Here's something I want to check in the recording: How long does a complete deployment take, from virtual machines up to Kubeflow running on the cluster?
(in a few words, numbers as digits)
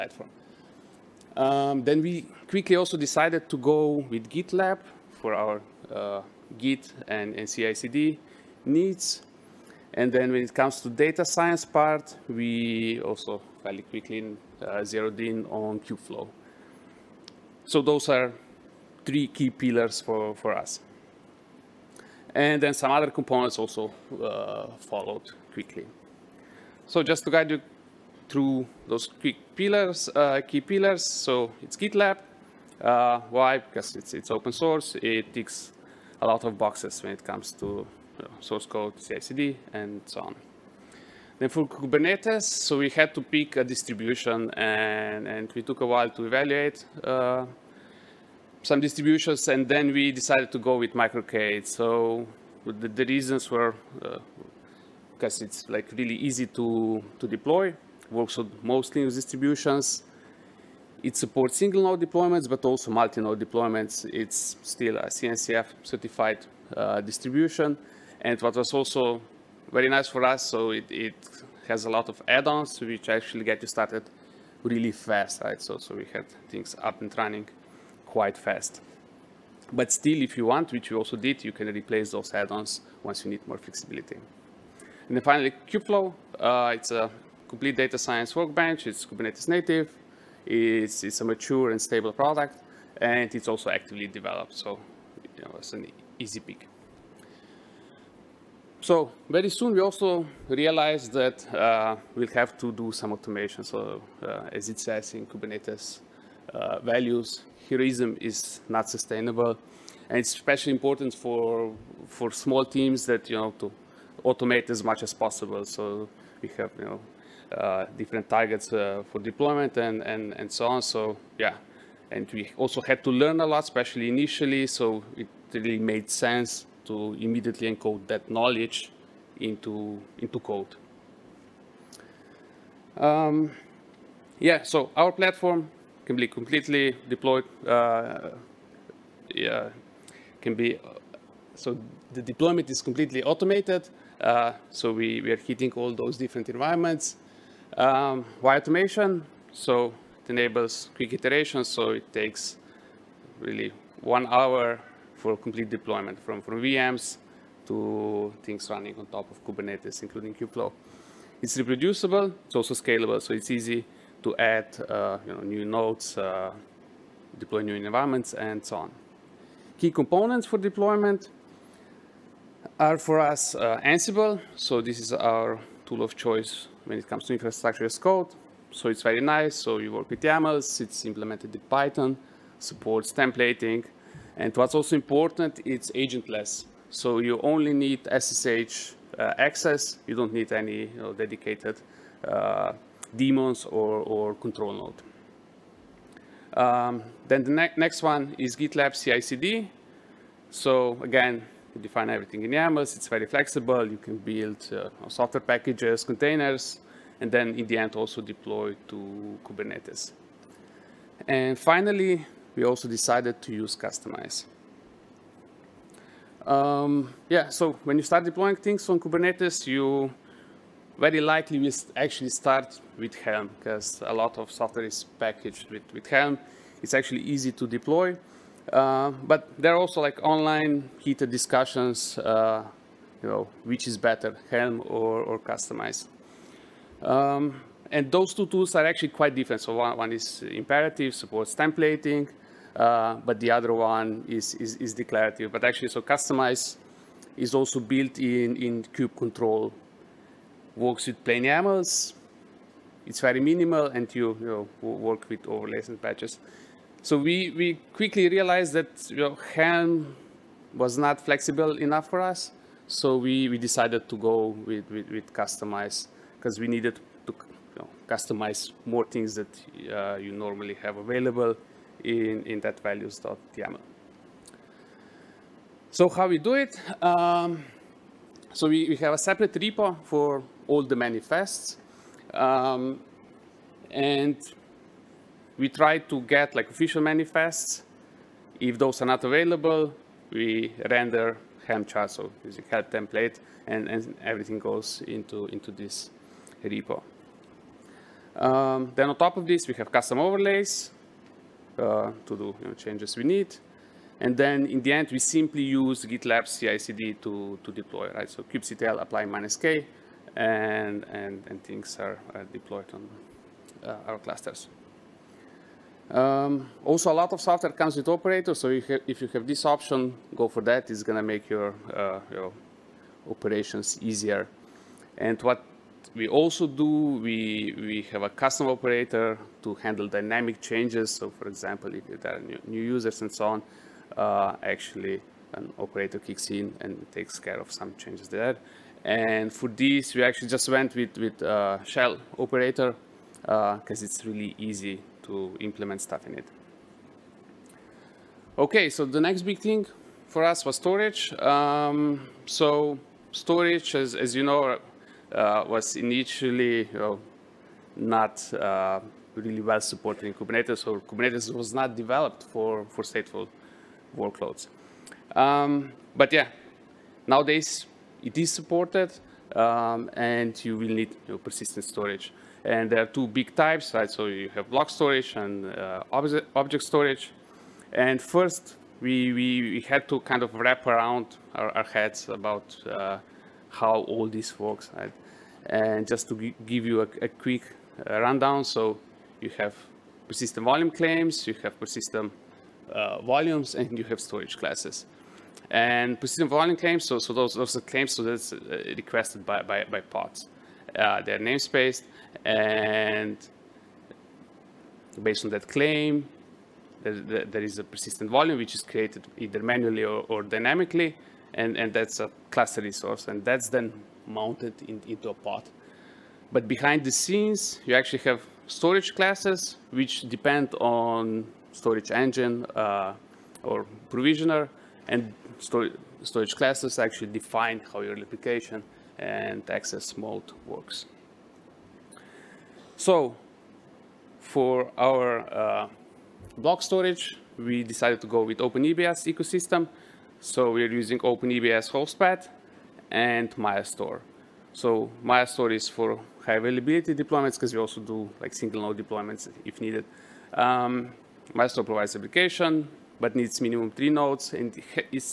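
1 hour.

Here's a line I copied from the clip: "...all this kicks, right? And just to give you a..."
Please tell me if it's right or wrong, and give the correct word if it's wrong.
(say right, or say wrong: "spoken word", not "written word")
wrong: "works", not "kicks".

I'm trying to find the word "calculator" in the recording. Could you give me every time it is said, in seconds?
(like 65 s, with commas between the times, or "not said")
not said.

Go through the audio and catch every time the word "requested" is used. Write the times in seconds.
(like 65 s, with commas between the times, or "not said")
398 s.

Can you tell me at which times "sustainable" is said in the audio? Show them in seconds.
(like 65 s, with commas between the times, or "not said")
108 s.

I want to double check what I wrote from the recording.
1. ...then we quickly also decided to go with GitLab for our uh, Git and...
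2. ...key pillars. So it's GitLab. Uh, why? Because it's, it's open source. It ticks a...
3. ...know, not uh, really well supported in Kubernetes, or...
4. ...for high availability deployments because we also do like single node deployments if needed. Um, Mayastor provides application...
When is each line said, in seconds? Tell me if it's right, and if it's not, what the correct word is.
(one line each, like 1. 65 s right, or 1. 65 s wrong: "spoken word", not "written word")
1. 1 s right
2. 30 s right
3. 356 s right
4. 445 s right.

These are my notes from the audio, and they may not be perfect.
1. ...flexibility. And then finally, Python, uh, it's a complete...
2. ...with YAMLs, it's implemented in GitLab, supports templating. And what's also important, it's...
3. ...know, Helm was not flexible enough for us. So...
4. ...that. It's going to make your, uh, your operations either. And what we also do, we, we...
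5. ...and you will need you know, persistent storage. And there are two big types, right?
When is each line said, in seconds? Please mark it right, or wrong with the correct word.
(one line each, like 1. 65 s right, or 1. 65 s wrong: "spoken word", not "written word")
1. 83 s wrong: "Kubeflow", not "Python"
2. 180 s wrong: "Python", not "GitLab"
3. 259 s right
4. 320 s wrong: "easier", not "either"
5. 370 s right.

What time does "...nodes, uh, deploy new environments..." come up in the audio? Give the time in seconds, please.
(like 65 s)
165 s.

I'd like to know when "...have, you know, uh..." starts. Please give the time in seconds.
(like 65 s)
116 s.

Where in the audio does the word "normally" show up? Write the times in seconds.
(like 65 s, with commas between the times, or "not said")
270 s.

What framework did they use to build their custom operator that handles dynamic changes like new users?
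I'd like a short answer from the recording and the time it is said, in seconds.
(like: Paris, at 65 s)
shell operator, at 341 s.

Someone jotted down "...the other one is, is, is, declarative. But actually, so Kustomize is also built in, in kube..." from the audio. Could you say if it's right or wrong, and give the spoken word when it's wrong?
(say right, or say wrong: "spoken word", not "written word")
right.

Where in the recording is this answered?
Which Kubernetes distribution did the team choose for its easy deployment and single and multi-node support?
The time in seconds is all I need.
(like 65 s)
50 s.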